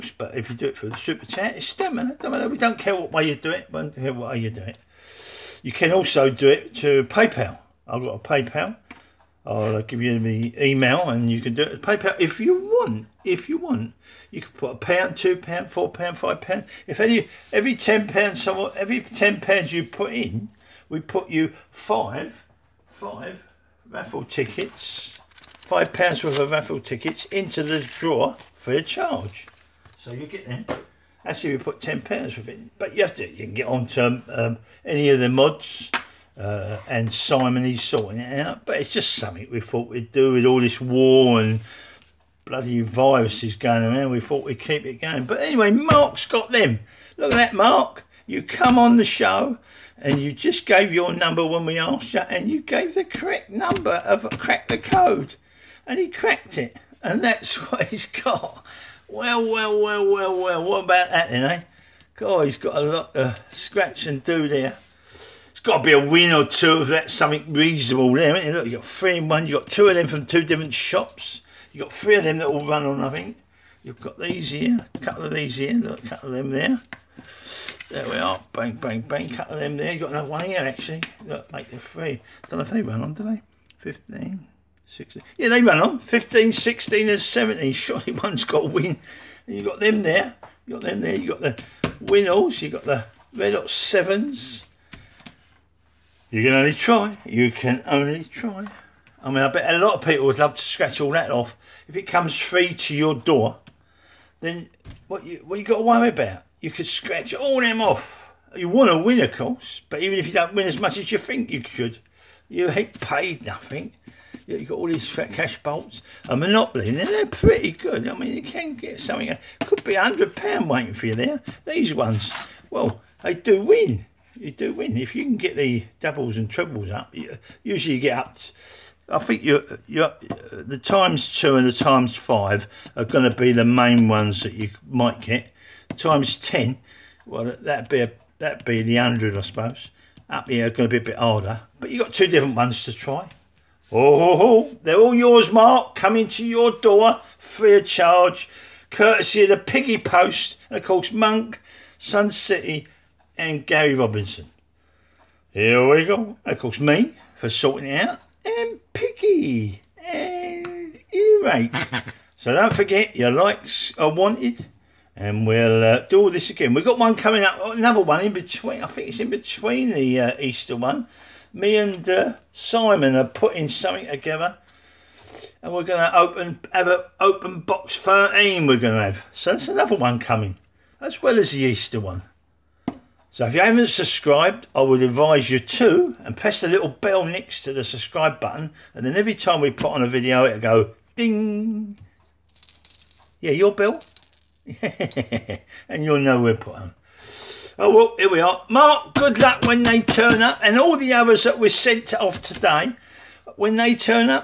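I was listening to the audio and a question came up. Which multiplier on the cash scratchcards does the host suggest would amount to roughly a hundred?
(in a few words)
Times ten.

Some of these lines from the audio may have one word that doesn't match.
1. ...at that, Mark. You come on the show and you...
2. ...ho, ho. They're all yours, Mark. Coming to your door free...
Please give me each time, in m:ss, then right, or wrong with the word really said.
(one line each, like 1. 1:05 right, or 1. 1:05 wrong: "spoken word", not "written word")
1. 0:47 right
2. 2:24 right.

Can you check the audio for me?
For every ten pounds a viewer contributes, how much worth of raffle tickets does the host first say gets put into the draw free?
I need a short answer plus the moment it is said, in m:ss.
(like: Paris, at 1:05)
£5, at 0:25.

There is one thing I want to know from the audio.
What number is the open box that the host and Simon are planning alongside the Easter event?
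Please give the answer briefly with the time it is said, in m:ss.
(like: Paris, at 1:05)
13, at 2:58.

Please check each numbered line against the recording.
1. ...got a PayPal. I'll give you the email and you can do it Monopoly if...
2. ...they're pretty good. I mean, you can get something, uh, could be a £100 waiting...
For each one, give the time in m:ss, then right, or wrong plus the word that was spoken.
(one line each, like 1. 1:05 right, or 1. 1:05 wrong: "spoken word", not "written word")
1. 0:08 wrong: "PayPal", not "Monopoly"
2. 1:56 right.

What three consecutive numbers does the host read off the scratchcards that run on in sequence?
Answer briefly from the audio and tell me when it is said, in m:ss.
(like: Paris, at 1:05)
15, 16 and 17, at 1:25.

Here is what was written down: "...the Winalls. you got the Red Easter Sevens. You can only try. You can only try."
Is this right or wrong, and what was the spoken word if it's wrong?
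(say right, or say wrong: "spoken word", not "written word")
wrong: "Hot", not "Easter".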